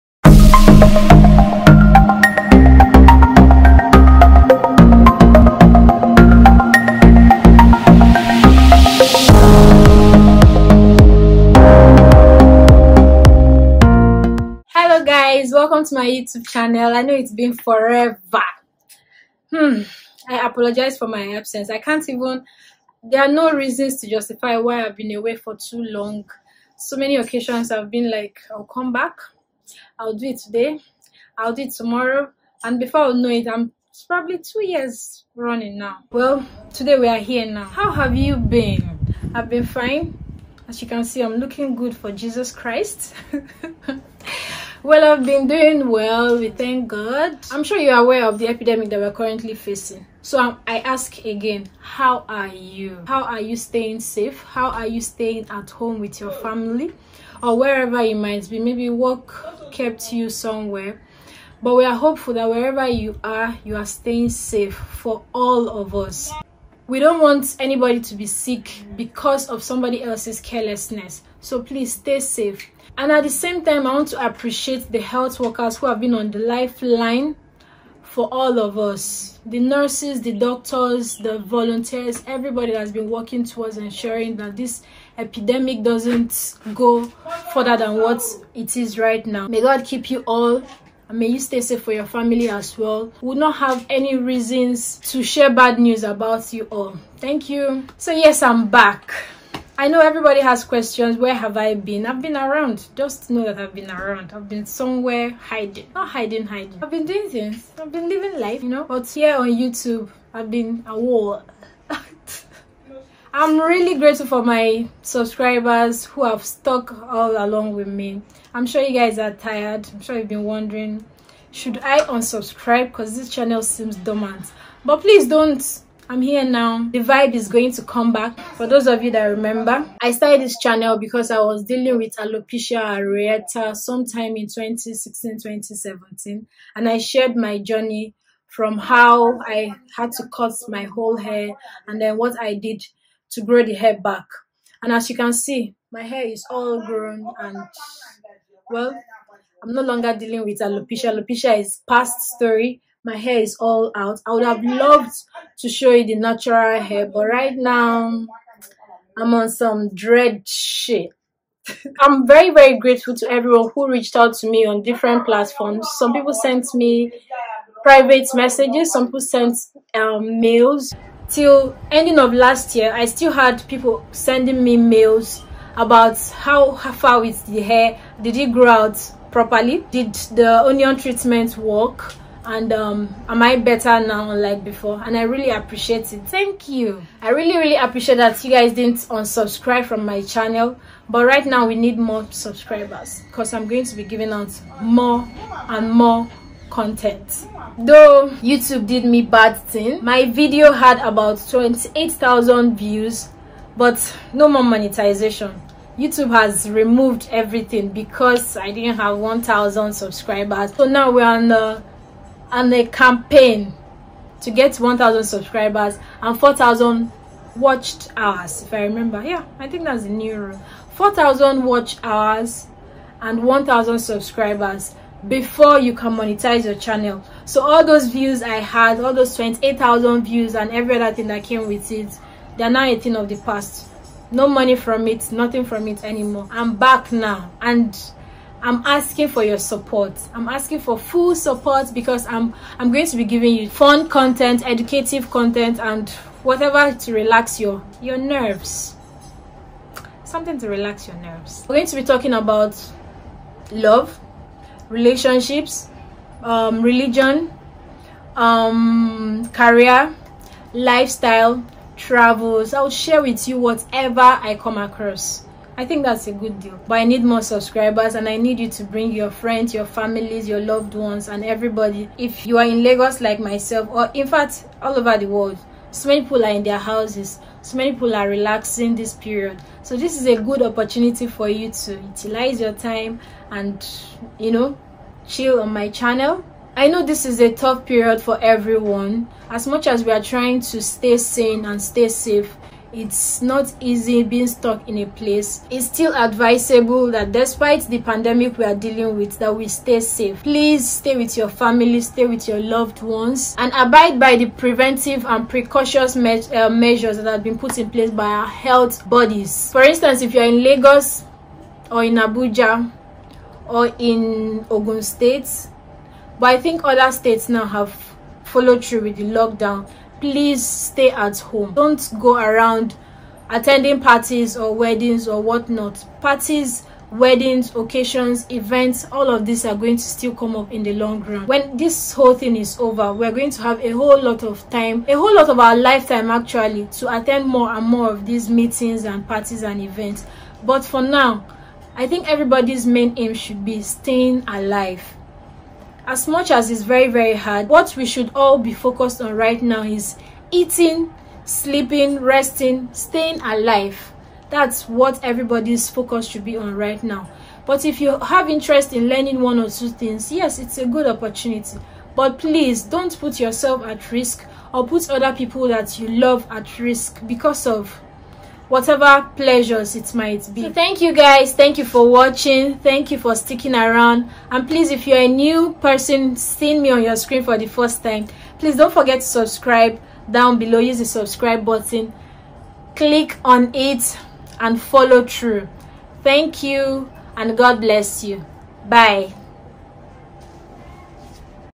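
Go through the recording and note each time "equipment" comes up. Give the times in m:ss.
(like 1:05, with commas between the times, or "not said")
not said.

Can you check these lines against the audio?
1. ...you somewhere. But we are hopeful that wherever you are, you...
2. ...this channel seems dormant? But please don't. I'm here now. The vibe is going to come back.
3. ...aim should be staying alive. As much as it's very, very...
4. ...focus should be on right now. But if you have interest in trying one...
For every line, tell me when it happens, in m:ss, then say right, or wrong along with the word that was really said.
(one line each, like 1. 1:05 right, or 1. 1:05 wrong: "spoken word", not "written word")
1. 1:00 right
2. 2:03 right
3. 5:43 right
4. 5:55 wrong: "learning", not "trying".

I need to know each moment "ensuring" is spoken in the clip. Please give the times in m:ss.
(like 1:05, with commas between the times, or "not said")
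1:23.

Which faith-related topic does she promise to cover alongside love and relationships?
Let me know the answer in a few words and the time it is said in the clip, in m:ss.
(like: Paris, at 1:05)
Religion, at 4:16.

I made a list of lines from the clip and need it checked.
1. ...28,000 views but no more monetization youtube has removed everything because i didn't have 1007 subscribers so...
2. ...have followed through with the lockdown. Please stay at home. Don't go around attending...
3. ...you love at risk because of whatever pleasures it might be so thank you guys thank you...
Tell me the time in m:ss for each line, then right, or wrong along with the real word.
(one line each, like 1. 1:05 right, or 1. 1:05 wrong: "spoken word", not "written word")
1. 3:21 wrong: "1000", not "1007"
2. 5:17 right
3. 6:05 right.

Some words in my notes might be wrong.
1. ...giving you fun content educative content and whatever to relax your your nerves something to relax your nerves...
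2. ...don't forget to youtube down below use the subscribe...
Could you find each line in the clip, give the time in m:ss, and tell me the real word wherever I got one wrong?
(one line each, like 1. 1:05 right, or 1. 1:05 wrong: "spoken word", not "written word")
1. 4:03 right
2. 6:18 wrong: "subscribe", not "youtube".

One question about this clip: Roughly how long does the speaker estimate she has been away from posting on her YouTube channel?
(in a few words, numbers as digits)
2 years.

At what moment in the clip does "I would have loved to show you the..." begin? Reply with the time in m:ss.
2:34.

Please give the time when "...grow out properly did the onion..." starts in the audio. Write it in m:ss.
2:58.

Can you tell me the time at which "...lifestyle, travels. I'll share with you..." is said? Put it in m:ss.
4:20.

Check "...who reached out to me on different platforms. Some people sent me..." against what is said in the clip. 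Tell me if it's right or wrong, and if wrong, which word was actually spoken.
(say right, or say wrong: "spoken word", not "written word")
right.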